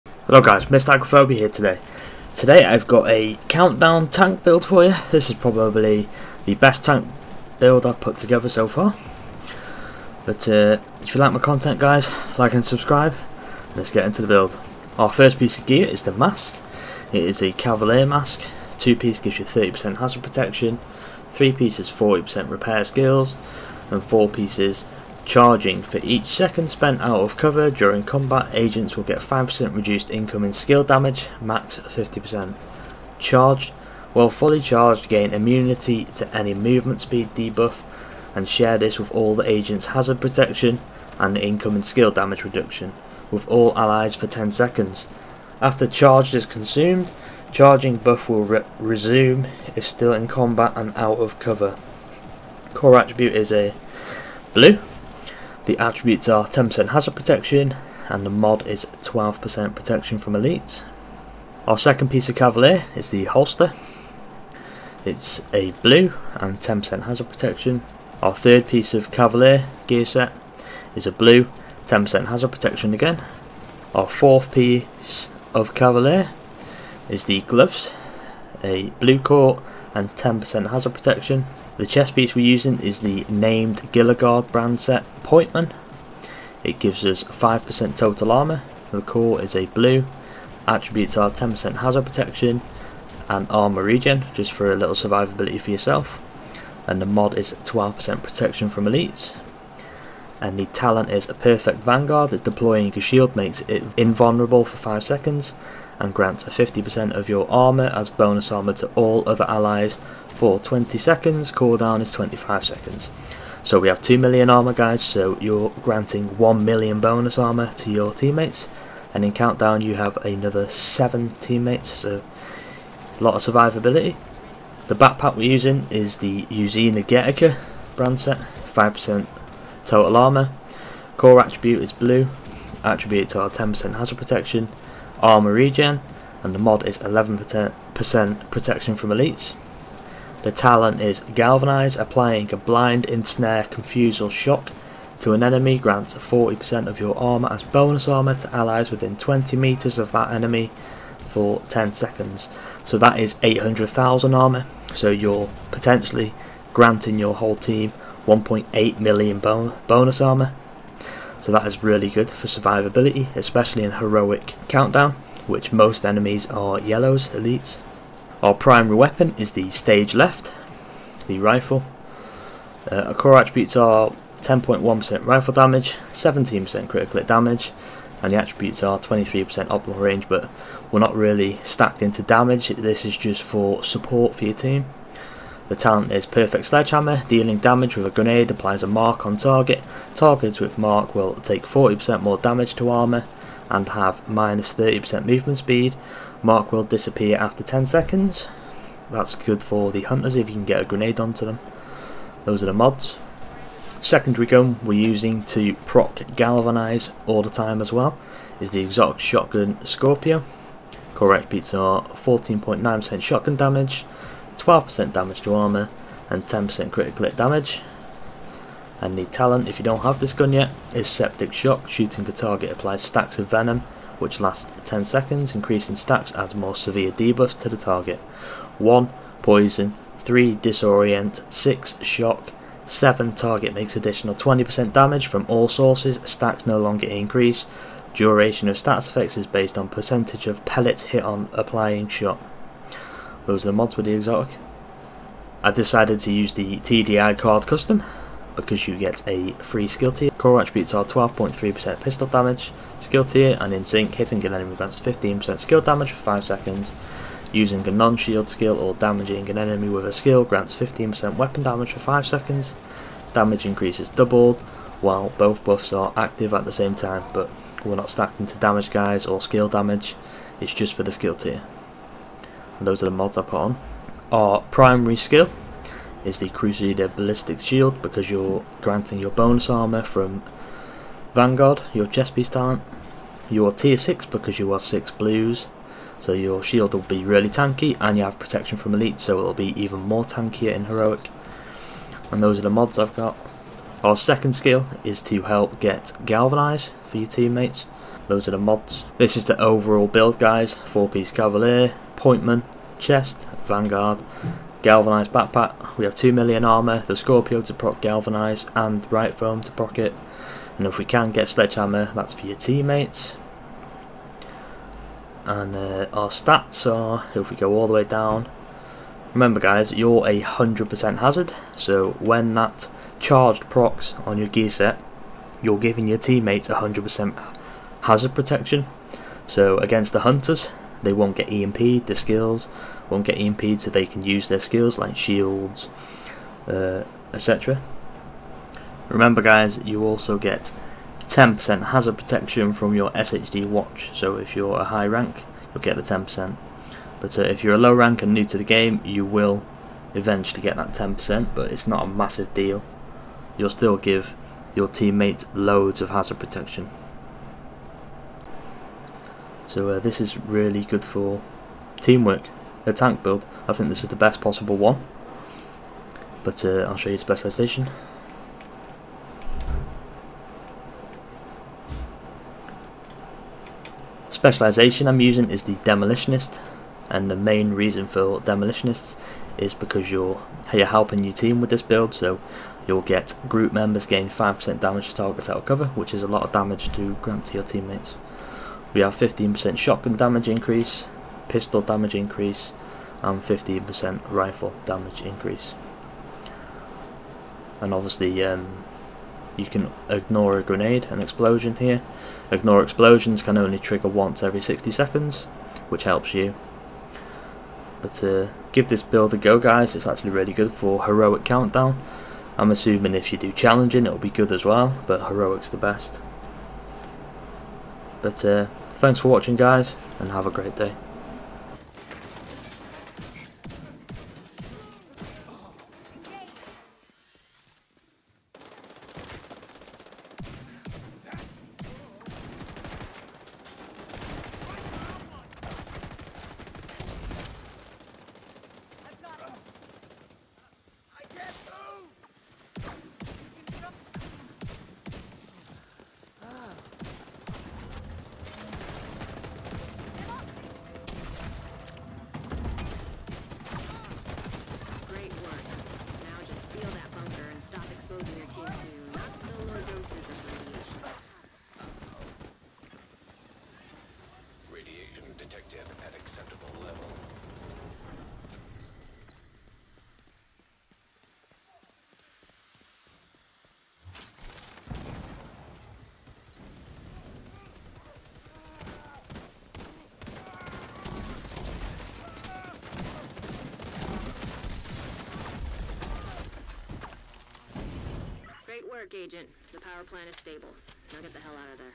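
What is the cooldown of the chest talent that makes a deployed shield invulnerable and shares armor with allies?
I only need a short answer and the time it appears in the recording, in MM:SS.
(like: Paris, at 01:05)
25 seconds, at 01:52.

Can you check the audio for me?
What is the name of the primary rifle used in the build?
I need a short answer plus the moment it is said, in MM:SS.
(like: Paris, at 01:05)
Stage Left, at 02:49.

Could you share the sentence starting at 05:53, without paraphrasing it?
You'll still give your teammates loads of hazard protection.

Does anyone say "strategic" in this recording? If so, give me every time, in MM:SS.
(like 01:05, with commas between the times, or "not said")
not said.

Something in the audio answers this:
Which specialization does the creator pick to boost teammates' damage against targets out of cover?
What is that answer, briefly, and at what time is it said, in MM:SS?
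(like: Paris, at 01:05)
Demolitionist, at 06:15.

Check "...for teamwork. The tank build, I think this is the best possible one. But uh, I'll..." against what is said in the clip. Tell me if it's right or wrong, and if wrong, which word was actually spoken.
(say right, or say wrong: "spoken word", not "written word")
right.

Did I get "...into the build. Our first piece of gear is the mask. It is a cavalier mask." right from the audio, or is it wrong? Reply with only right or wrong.
right.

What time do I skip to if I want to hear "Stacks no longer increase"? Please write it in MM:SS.
03:56.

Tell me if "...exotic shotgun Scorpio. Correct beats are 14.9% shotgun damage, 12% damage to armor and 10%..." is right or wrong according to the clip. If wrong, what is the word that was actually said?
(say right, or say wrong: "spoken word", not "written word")
right.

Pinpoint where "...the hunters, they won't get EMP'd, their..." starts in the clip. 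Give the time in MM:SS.
05:30.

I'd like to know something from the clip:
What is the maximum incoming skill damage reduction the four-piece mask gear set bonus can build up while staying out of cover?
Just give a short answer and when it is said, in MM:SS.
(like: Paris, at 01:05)
50%, at 00:31.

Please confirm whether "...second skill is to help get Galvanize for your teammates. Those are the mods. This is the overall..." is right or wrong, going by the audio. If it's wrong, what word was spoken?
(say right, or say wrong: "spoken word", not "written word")
right.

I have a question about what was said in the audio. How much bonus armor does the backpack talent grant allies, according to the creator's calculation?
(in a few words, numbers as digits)
800,000.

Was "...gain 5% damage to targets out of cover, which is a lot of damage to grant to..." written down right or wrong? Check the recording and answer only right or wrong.
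right.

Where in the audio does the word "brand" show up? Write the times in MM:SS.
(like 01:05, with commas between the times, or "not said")
01:24, 02:07.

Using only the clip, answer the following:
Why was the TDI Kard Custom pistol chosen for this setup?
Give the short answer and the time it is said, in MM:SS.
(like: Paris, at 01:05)
free skill tier, at 04:09.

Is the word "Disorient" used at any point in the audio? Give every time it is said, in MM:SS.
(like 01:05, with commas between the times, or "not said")
03:50.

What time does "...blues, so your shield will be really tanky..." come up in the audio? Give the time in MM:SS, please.
04:45.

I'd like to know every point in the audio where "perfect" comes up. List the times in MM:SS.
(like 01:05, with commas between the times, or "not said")
01:41, 03:06.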